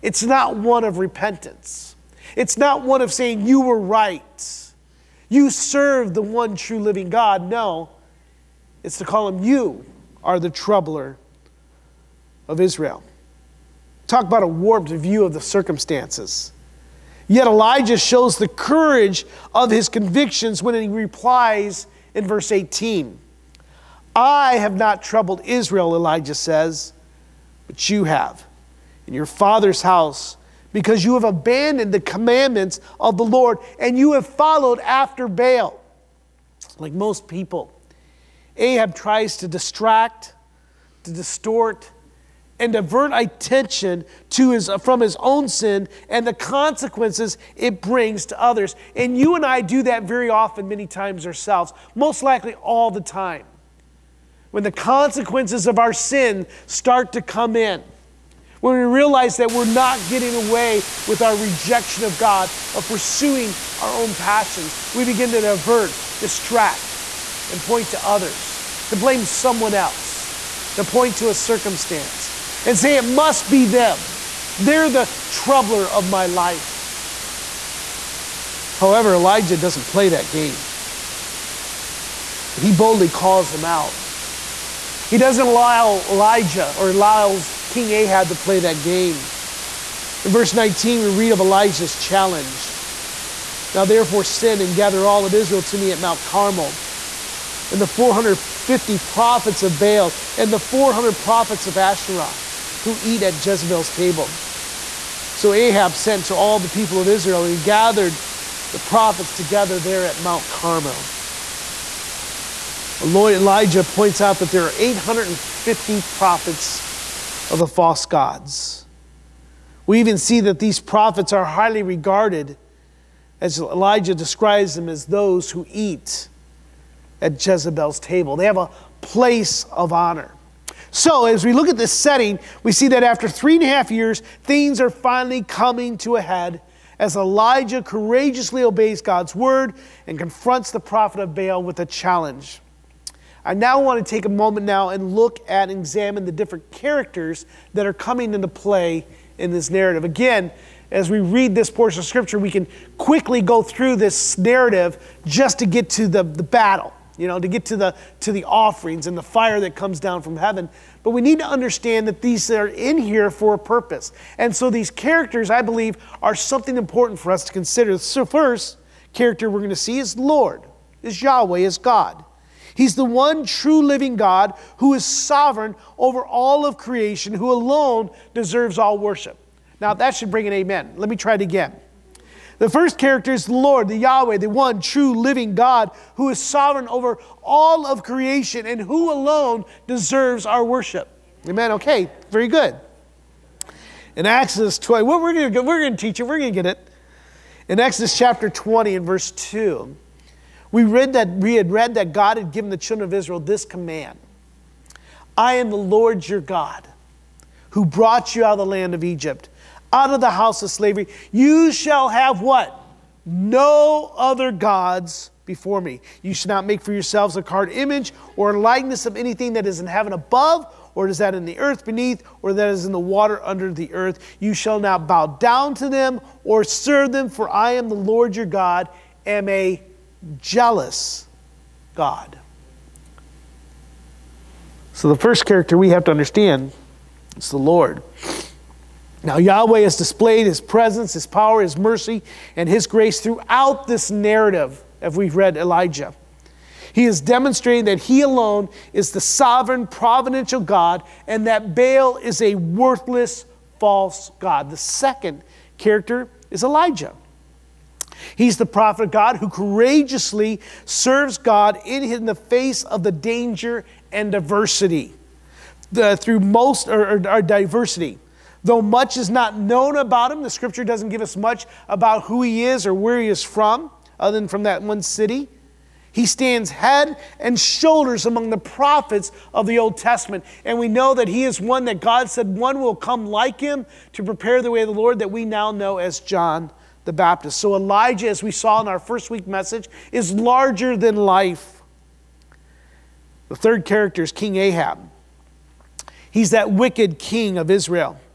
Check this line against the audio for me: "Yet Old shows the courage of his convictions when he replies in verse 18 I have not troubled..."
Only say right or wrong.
wrong.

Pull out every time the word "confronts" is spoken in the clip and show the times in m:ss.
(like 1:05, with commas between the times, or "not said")
2:20.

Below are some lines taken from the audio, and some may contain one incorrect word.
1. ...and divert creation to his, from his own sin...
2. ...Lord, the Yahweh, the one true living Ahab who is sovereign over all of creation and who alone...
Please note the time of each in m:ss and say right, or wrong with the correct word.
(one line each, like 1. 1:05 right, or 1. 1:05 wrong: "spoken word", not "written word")
1. 0:42 wrong: "attention", not "creation"
2. 3:03 wrong: "God", not "Ahab".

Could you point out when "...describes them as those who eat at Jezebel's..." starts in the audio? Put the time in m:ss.
2:04.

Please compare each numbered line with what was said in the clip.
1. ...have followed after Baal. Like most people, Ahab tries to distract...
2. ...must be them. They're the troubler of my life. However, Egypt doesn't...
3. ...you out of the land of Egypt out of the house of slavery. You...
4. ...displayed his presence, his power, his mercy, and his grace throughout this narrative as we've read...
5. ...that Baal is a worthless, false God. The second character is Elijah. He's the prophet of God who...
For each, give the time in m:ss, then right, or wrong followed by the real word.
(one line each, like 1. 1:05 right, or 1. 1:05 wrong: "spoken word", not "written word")
1. 0:34 right
2. 1:13 wrong: "Elijah", not "Egypt"
3. 3:28 right
4. 3:59 right
5. 4:11 right.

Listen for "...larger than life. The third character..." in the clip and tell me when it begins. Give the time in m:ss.
4:50.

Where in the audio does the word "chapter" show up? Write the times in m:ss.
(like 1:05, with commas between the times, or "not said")
3:18.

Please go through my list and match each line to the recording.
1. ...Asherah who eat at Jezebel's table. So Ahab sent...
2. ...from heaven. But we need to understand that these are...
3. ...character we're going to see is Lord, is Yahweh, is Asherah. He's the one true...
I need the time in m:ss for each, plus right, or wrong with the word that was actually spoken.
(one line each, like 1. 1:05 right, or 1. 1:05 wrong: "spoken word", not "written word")
1. 1:41 right
2. 2:40 right
3. 2:49 wrong: "God", not "Asherah".